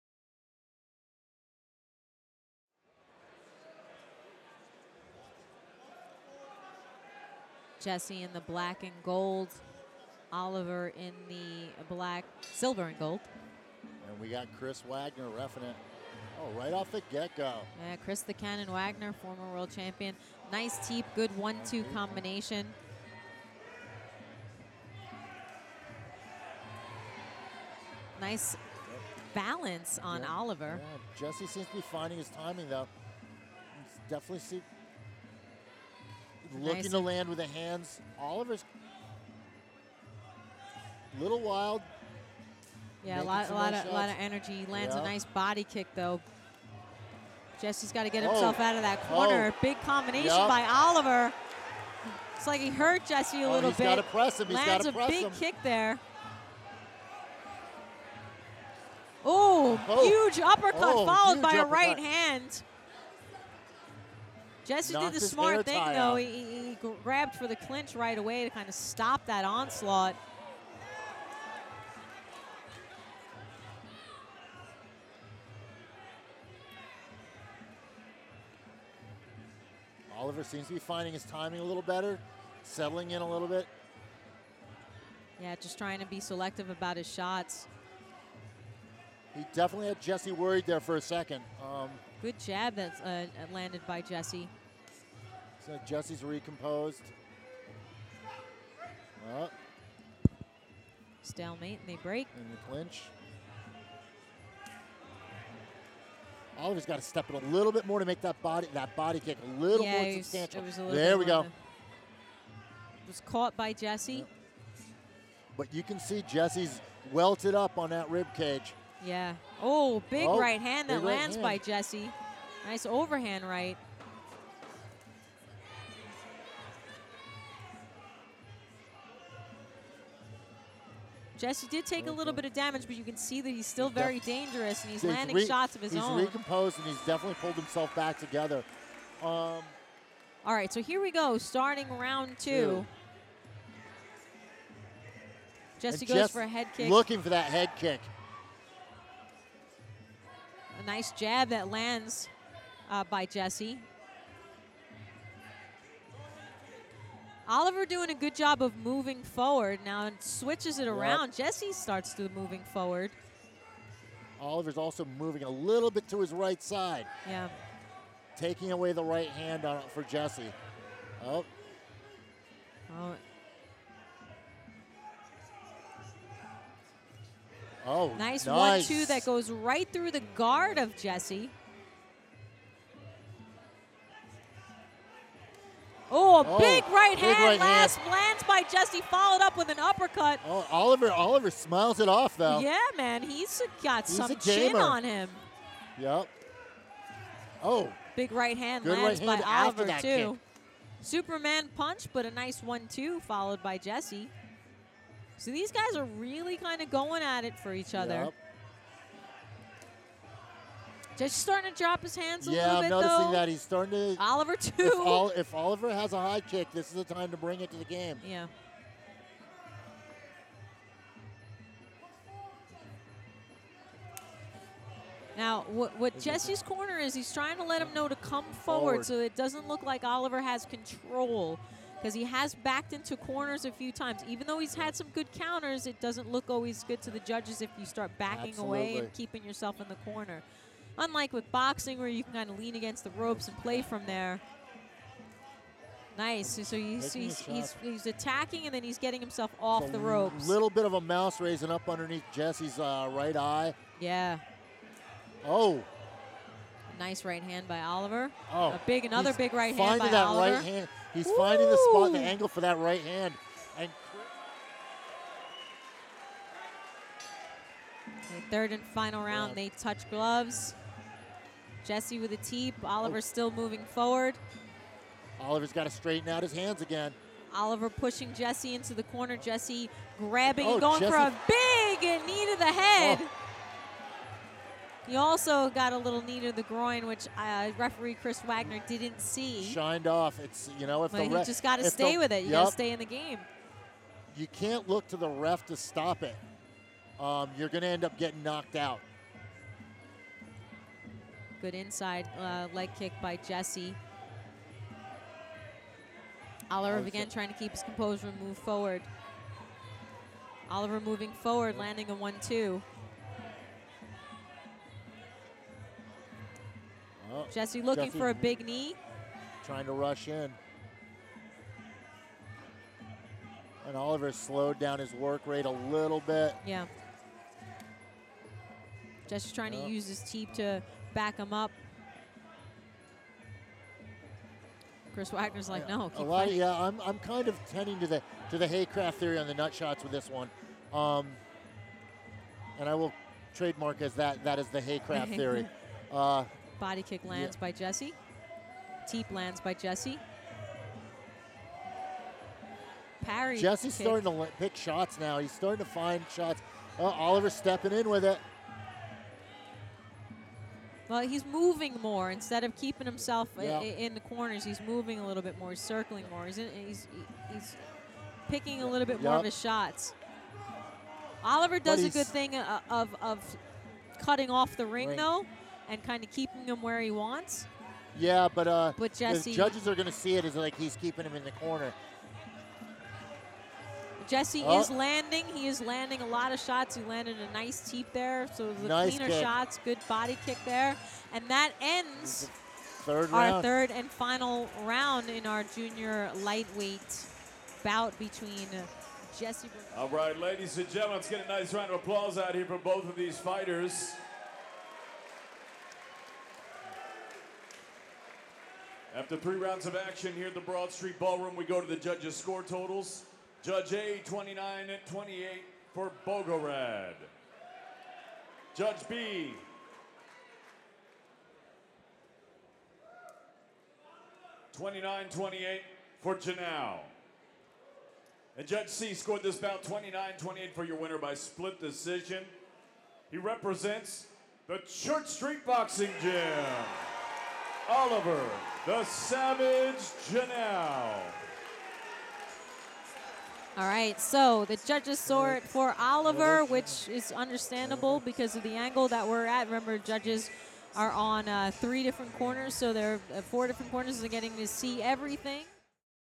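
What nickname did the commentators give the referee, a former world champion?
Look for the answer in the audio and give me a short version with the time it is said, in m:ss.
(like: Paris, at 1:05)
the Cannon, at 0:17.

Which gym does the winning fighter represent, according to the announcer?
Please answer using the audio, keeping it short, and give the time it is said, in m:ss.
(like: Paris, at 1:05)
Church Street Boxing Gym, at 7:14.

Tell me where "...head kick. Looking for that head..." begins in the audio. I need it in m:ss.
2:26.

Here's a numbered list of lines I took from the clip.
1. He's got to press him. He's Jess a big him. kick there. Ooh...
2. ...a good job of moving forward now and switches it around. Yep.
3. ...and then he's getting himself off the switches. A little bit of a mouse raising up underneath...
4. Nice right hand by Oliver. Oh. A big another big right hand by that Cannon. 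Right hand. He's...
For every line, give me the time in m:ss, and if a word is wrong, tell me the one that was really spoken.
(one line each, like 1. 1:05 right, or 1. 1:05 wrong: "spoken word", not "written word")
1. 0:53 wrong: "Lands", not "Jess"
2. 2:38 right
3. 4:08 wrong: "ropes", not "switches"
4. 4:16 wrong: "Oliver", not "Cannon".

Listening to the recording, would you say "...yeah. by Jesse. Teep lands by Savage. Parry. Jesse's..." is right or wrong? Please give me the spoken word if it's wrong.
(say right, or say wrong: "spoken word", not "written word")
wrong: "Jesse", not "Savage".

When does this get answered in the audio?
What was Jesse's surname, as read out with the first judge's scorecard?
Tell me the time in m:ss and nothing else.
6:56.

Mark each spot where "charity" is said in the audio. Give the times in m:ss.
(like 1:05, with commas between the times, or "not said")
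not said.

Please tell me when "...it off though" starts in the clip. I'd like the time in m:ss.
3:11.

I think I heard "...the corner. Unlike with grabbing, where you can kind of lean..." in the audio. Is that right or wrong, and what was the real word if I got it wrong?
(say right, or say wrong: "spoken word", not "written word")
wrong: "boxing", not "grabbing".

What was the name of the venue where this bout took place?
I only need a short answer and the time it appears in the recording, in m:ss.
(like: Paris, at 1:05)
Broad Street Ballroom, at 6:50.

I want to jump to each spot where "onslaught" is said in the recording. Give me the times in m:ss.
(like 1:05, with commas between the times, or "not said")
1:09.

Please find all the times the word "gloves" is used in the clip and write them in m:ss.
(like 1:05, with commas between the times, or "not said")
4:30.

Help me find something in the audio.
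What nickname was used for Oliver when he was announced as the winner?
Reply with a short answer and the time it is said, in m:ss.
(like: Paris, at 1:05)
the Savage, at 7:17.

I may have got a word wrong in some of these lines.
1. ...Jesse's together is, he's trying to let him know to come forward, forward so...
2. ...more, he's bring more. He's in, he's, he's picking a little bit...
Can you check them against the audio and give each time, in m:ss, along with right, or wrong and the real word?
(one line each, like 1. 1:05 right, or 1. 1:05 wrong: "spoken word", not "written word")
1. 3:46 wrong: "corner", not "together"
2. 6:05 wrong: "circling", not "bring".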